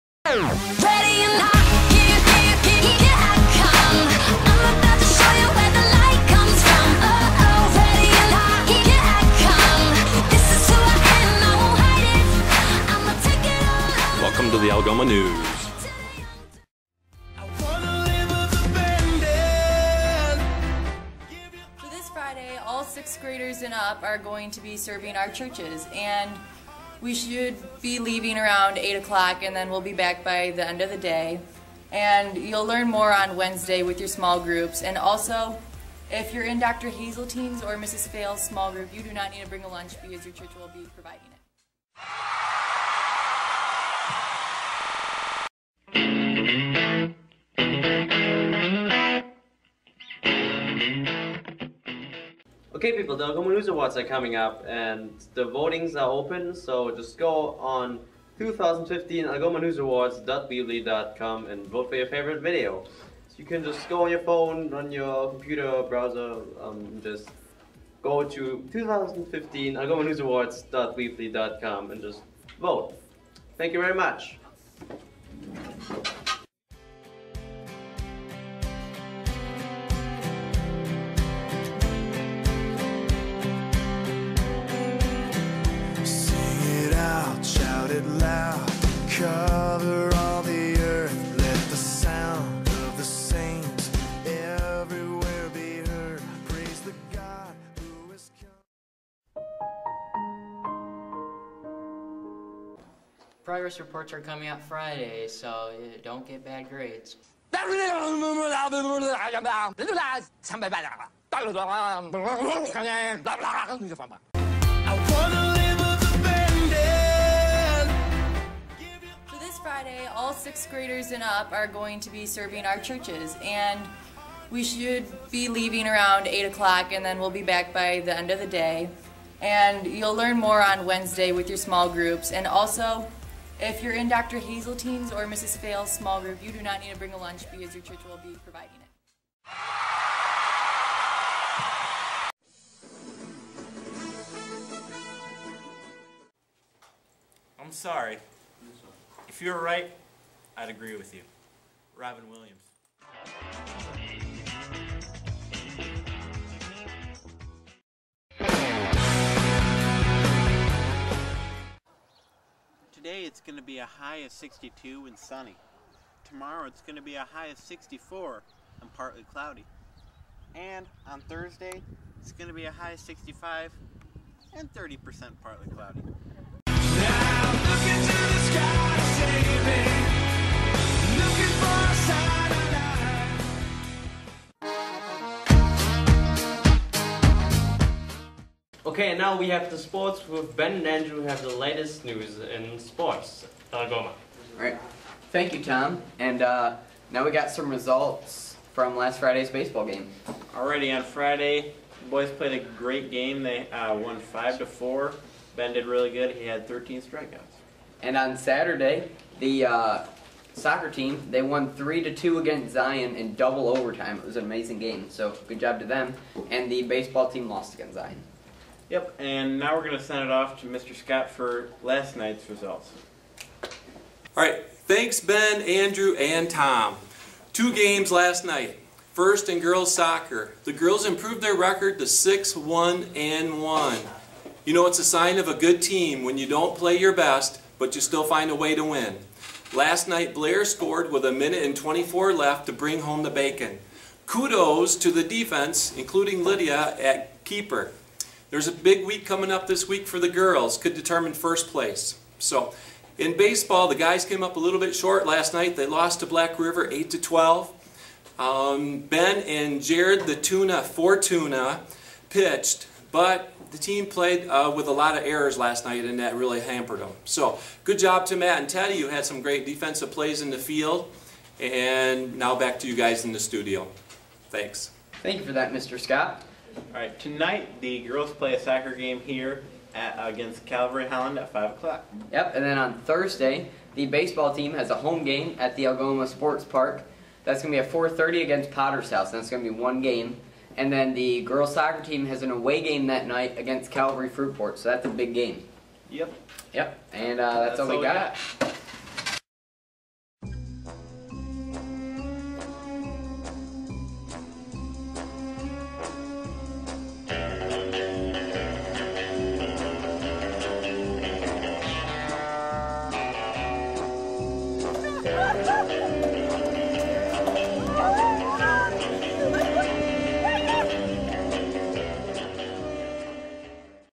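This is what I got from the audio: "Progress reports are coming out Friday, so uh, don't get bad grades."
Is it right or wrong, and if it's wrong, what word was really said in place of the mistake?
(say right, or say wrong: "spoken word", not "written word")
right.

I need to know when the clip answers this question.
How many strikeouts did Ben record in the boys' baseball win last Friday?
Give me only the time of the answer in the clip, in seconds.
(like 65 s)
206 s.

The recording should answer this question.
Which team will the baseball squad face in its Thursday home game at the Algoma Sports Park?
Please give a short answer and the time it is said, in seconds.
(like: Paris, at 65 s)
Potter's House, at 288 s.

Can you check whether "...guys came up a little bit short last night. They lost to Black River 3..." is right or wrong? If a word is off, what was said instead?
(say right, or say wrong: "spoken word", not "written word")
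wrong: "8", not "3".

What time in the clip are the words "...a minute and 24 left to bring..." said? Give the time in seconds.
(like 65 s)
241 s.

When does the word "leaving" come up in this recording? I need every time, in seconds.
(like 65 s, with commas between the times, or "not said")
27 s, 125 s.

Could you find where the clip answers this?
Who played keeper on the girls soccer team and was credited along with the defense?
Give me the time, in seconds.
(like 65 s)
246 s.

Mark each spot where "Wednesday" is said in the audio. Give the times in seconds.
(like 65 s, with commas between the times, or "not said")
33 s, 130 s.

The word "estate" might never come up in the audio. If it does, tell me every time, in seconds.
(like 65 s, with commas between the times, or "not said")
not said.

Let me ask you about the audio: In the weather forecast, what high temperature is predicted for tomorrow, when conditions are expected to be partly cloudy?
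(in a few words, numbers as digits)
64.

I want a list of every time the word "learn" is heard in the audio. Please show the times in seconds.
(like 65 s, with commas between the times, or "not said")
32 s, 130 s.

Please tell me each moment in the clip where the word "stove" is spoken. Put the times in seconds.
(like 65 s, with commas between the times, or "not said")
not said.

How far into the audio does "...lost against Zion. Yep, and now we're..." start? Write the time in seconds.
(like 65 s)
217 s.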